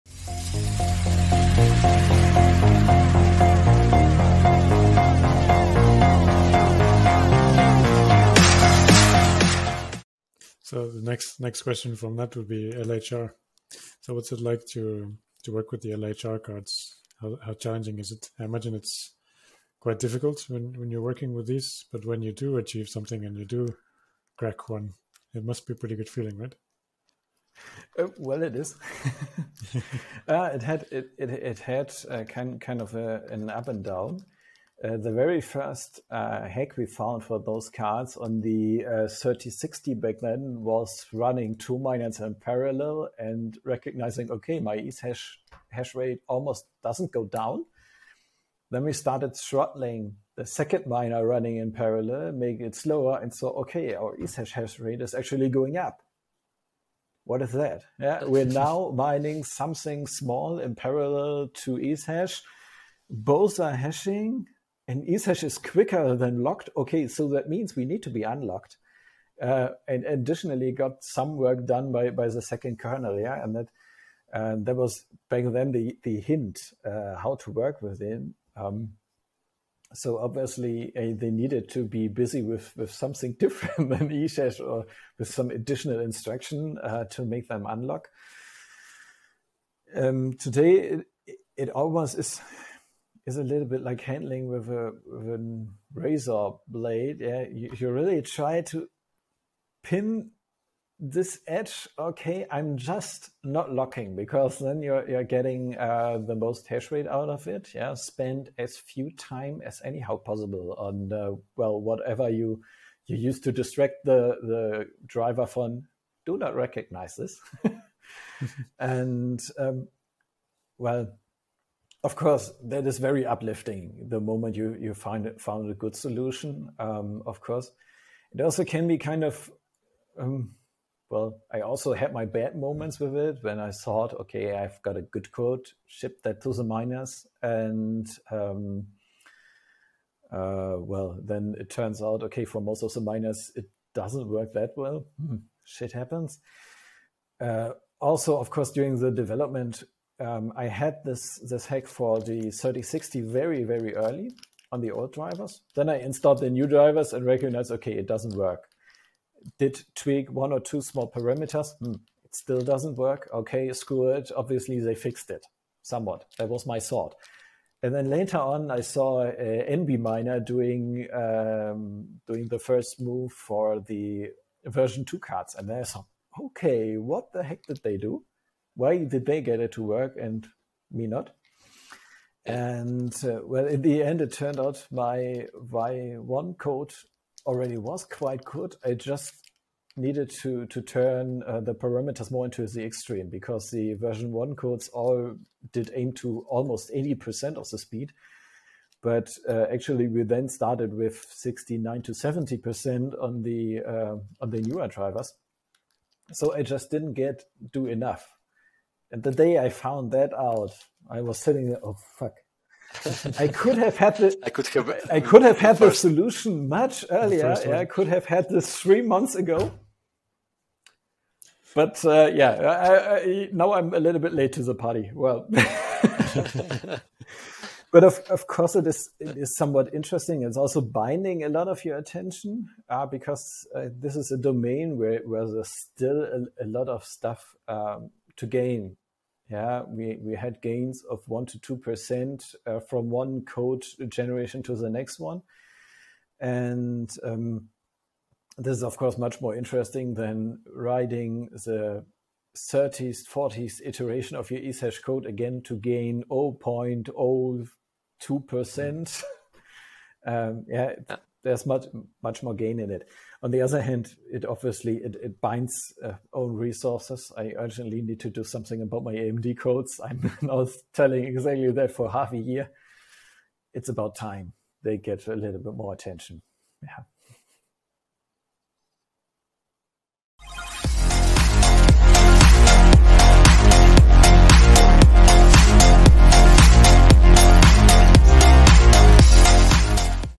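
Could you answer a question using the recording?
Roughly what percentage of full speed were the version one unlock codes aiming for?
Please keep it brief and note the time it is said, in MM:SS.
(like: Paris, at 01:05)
80%, at 03:16.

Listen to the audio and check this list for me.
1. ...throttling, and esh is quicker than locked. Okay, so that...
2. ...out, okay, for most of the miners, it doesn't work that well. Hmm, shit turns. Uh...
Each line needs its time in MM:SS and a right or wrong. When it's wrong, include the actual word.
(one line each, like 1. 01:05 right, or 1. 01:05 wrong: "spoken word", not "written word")
1. 01:03 wrong: "hashing", not "throttling"
2. 02:22 wrong: "happens", not "turns".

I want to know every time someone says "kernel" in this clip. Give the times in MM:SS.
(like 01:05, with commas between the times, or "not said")
01:12.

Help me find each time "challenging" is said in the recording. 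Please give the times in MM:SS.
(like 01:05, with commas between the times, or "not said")
00:17.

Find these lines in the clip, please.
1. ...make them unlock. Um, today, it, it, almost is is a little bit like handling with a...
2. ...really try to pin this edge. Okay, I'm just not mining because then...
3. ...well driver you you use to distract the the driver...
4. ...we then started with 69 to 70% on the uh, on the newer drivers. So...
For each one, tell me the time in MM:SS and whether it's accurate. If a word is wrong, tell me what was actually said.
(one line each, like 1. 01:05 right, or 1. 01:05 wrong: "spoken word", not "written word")
1. 01:27 right
2. 01:37 wrong: "locking", not "mining"
3. 01:51 wrong: "whatever", not "driver"
4. 03:20 right.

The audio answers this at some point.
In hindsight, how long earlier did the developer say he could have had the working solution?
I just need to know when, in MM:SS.
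03:38.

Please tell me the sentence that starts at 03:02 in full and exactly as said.
And uh, well, in the end, it turned out my Y1 code already was quite good.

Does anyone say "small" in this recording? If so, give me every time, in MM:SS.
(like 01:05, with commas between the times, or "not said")
01:00, 02:40.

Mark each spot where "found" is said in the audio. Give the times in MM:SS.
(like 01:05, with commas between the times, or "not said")
00:36, 02:05, 03:29.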